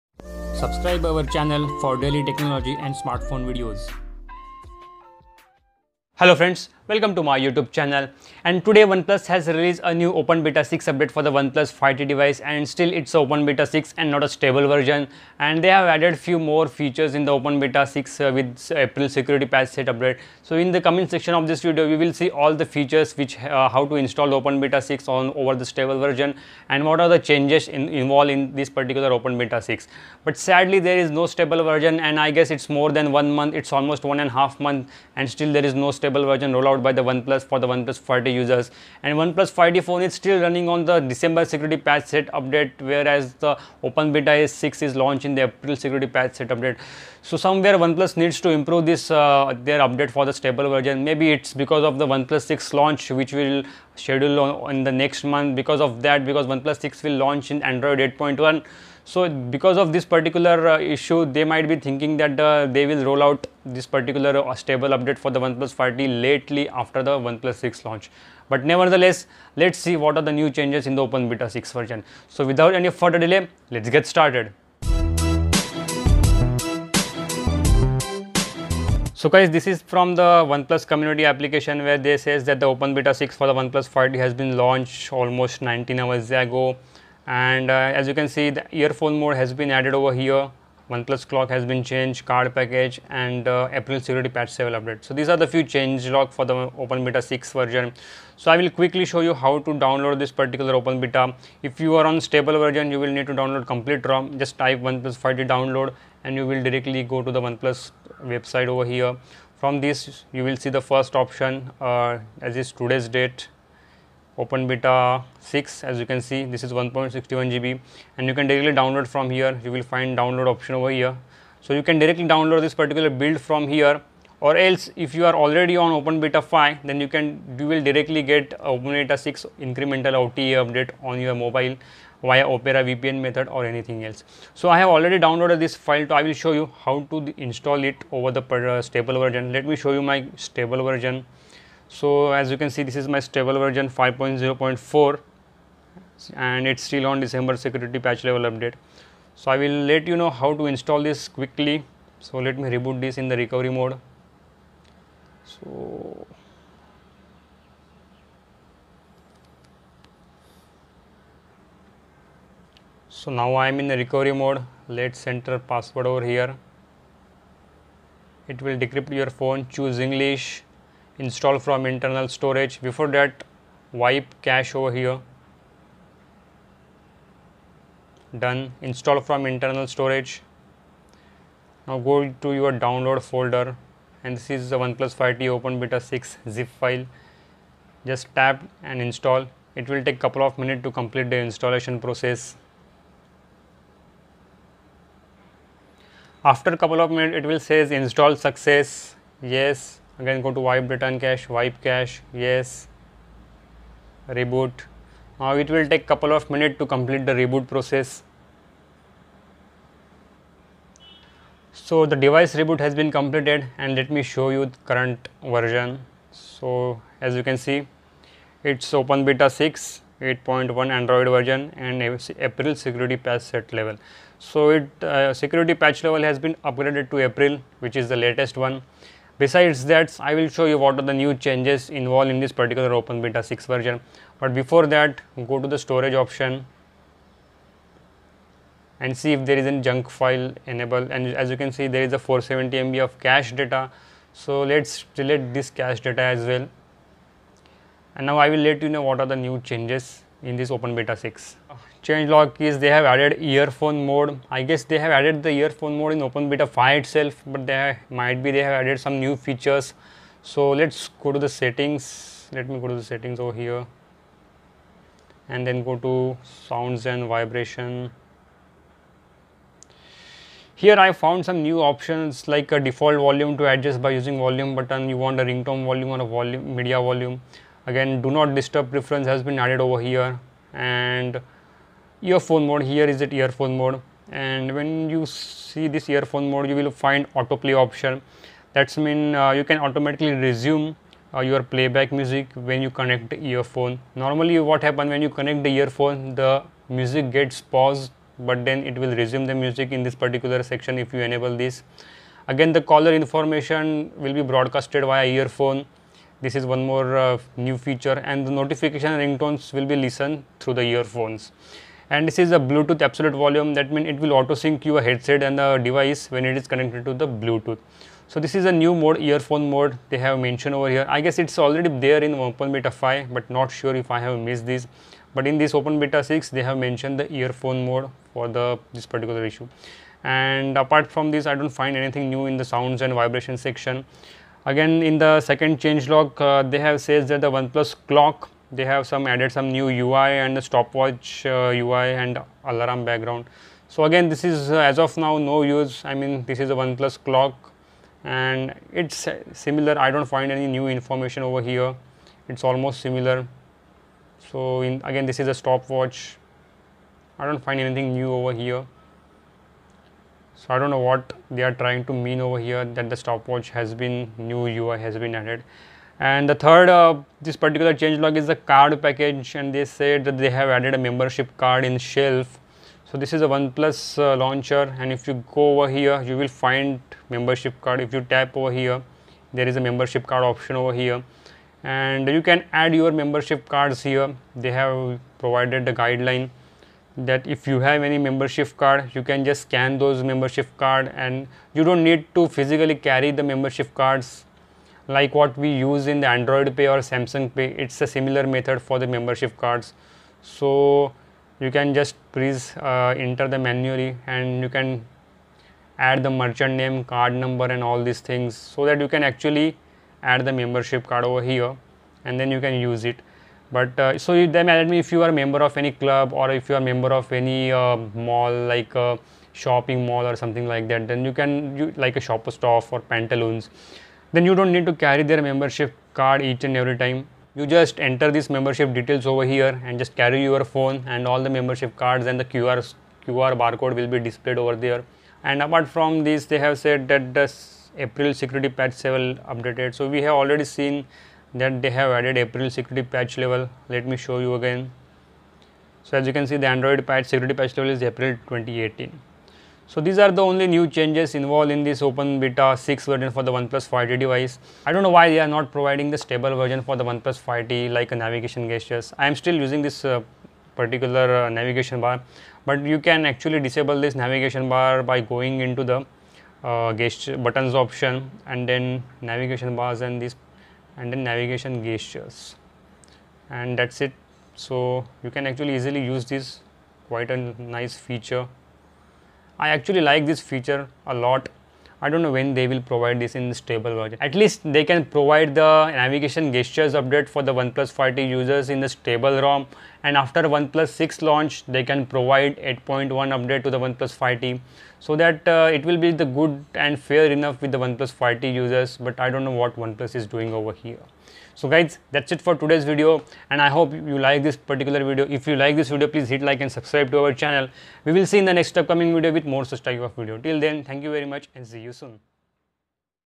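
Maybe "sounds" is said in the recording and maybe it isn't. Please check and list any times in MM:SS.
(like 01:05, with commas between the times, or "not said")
04:26, 05:32.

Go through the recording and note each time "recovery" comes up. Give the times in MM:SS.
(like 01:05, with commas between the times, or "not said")
02:33, 02:43.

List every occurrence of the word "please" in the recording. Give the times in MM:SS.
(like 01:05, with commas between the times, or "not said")
06:42, 08:26.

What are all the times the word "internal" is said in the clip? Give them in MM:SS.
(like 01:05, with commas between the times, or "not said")
02:51, 02:59.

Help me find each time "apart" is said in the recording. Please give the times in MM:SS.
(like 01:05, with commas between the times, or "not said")
05:30, 07:15.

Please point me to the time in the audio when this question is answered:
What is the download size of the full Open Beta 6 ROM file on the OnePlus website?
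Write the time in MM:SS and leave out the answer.
01:56.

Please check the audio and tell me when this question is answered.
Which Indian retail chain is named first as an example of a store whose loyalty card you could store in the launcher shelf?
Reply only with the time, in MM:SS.
07:02.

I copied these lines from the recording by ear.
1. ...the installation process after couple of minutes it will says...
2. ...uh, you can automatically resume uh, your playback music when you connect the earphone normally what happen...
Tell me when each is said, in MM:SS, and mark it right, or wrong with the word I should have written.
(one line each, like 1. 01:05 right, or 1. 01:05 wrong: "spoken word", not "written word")
1. 03:11 right
2. 04:49 right.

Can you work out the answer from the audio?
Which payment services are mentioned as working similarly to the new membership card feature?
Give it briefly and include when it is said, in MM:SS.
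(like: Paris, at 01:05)
Android Pay or Samsung Pay, at 06:36.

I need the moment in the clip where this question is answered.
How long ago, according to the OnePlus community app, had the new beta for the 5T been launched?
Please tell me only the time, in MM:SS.
01:25.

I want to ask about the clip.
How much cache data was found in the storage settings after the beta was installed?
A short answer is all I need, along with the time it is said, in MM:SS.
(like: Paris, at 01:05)
470 MB, at 04:02.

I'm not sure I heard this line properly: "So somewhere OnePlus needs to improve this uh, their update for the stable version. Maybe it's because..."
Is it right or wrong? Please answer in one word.
right.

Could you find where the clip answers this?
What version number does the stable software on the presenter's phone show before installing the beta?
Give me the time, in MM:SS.
02:23.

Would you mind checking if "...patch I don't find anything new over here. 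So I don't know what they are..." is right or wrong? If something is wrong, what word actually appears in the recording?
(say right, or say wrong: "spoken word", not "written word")
wrong: "stopwatch", not "patch".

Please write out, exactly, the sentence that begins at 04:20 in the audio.
So let's go to the settings.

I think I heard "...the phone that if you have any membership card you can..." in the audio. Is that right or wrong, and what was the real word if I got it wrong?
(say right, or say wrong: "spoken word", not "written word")
wrong: "guideline", not "phone".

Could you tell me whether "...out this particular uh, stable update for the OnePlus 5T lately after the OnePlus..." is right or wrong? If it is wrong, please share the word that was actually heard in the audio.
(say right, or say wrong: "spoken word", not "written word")
right.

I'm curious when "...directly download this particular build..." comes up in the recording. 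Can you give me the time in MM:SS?
02:01.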